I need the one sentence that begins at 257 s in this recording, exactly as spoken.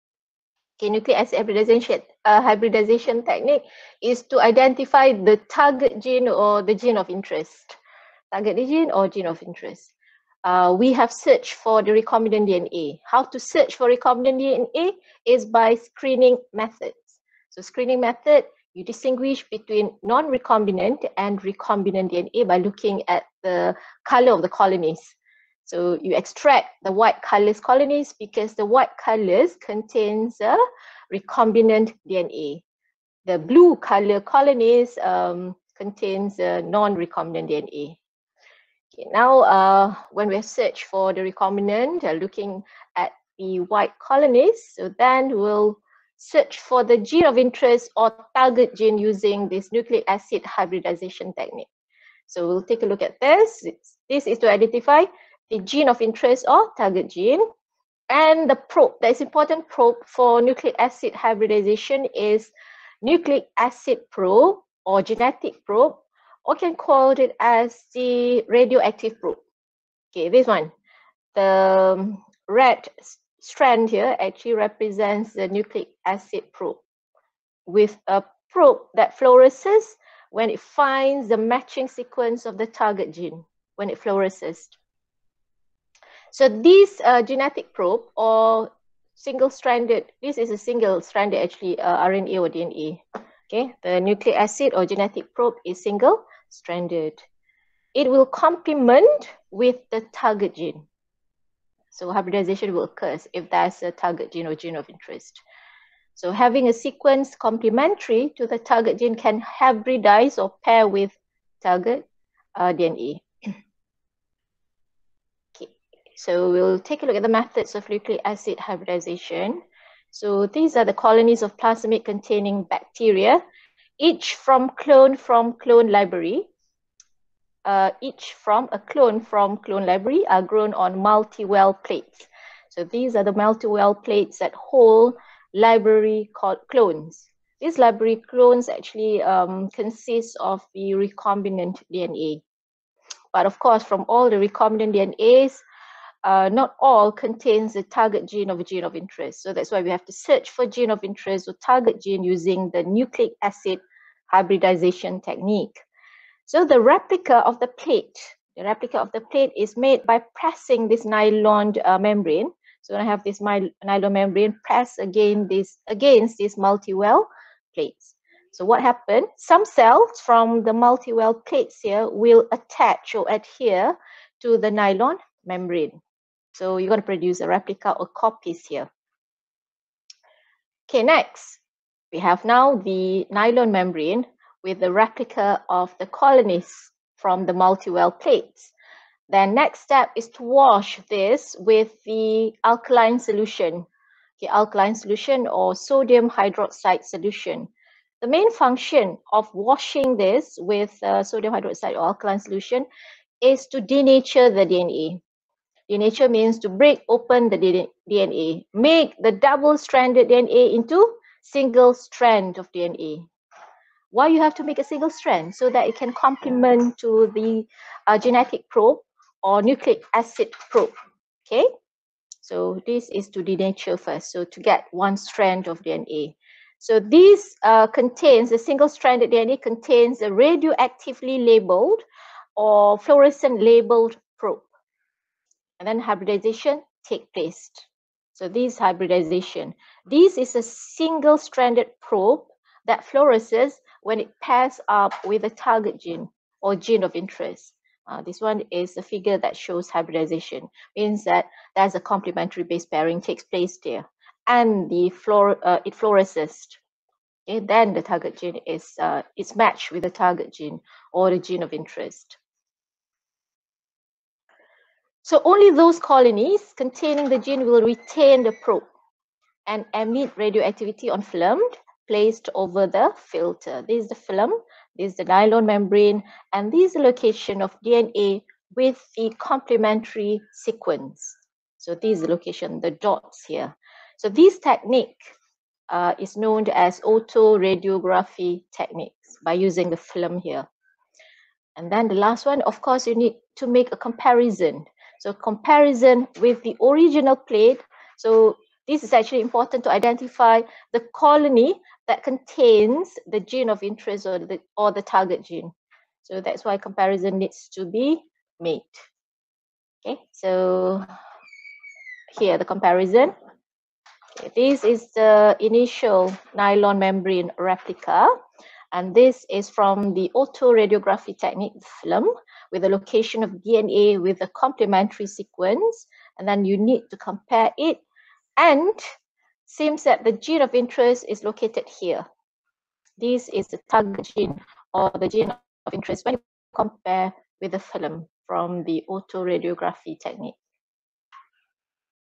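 Okay, then the target gene is uh, is matched with the target gene or the gene of interest.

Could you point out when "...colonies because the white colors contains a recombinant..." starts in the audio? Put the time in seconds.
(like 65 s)
27 s.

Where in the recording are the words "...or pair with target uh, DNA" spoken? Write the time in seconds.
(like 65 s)
110 s.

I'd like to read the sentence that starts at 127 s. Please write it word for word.
Uh, each from a clone from clone library are grown on multi-well plates.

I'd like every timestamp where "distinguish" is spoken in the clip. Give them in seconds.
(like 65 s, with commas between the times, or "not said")
18 s.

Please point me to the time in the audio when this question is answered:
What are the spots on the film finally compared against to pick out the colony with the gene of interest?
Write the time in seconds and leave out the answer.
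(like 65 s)
296 s.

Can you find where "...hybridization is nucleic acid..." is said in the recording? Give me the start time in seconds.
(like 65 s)
61 s.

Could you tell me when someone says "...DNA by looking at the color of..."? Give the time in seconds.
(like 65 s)
22 s.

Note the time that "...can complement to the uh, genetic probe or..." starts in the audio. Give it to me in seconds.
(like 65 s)
215 s.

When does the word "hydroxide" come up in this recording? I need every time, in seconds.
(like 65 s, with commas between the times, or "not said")
196 s, 201 s.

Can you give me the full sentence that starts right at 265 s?
So only those colonies containing the gene will retain the probe and emit radioactivity on film placed over the filter.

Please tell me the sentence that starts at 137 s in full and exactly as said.
These library clones actually um, consist of the recombinant DNA.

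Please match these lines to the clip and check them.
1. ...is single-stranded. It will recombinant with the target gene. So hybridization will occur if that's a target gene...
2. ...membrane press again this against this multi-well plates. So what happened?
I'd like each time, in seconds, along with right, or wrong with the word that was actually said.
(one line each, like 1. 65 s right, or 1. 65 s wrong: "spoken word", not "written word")
1. 95 s wrong: "complement", not "recombinant"
2. 164 s right.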